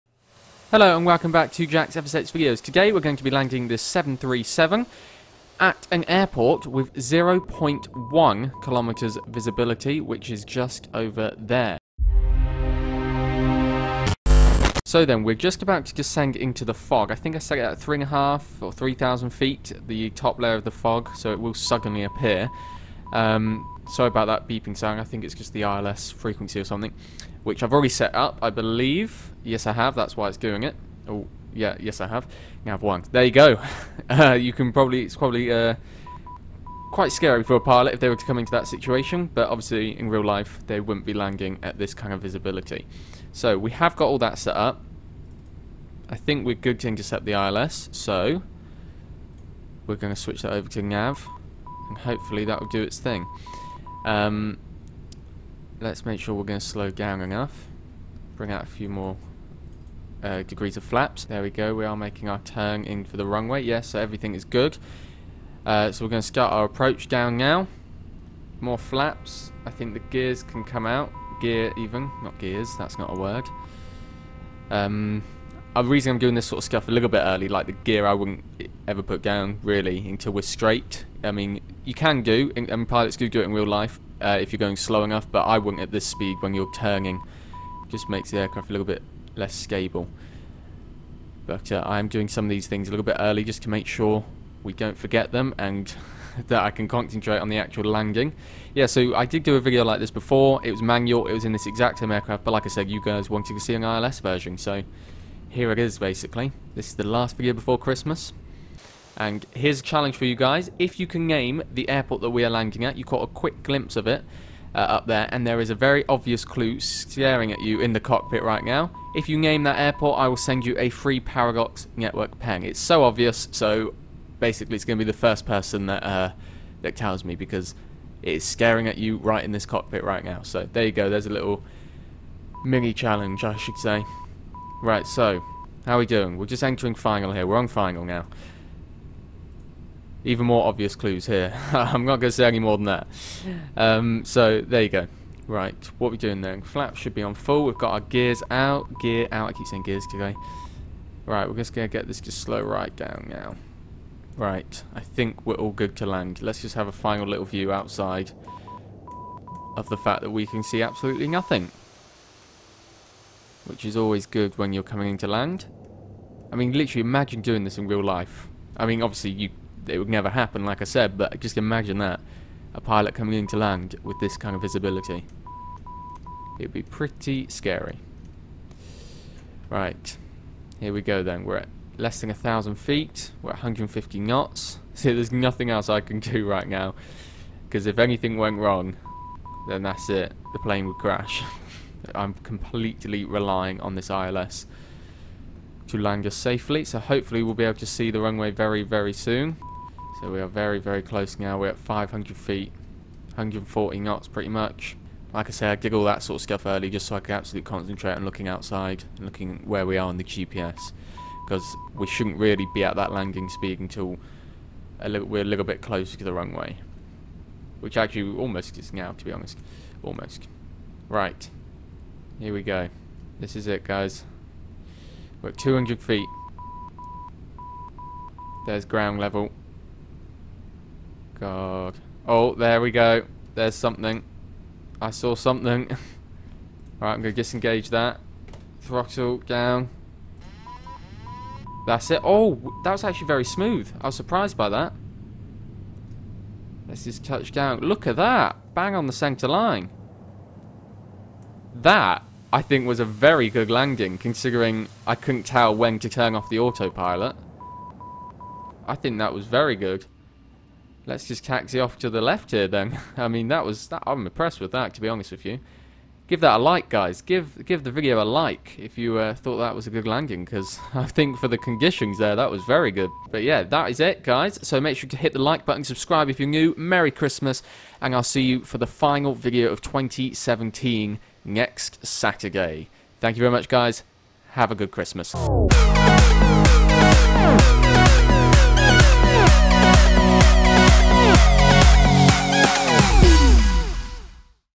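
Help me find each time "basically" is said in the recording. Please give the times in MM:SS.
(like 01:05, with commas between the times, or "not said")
01:45, 02:04.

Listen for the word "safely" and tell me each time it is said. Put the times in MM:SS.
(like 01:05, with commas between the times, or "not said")
03:16.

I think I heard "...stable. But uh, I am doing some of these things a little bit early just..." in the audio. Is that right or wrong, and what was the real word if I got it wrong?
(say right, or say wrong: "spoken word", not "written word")
right.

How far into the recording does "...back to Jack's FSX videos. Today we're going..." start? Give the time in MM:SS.
00:01.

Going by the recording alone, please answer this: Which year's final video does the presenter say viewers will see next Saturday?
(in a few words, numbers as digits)
2017.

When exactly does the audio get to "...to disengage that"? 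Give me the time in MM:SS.
03:57.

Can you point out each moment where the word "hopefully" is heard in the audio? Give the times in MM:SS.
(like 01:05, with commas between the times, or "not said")
00:51, 03:16.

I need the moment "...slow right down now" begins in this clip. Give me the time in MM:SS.
02:32.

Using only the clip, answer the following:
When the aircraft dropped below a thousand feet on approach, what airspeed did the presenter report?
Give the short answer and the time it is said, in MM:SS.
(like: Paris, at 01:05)
150 knots, at 03:03.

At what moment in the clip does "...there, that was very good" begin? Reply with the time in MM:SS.
04:32.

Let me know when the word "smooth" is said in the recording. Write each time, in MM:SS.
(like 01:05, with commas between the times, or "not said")
04:03.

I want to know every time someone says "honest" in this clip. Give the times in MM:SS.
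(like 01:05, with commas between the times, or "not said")
03:39, 04:25.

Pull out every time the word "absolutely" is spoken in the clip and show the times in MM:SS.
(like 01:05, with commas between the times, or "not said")
02:40, 03:27.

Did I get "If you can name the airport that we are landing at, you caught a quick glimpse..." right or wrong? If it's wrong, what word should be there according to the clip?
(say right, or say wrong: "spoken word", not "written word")
right.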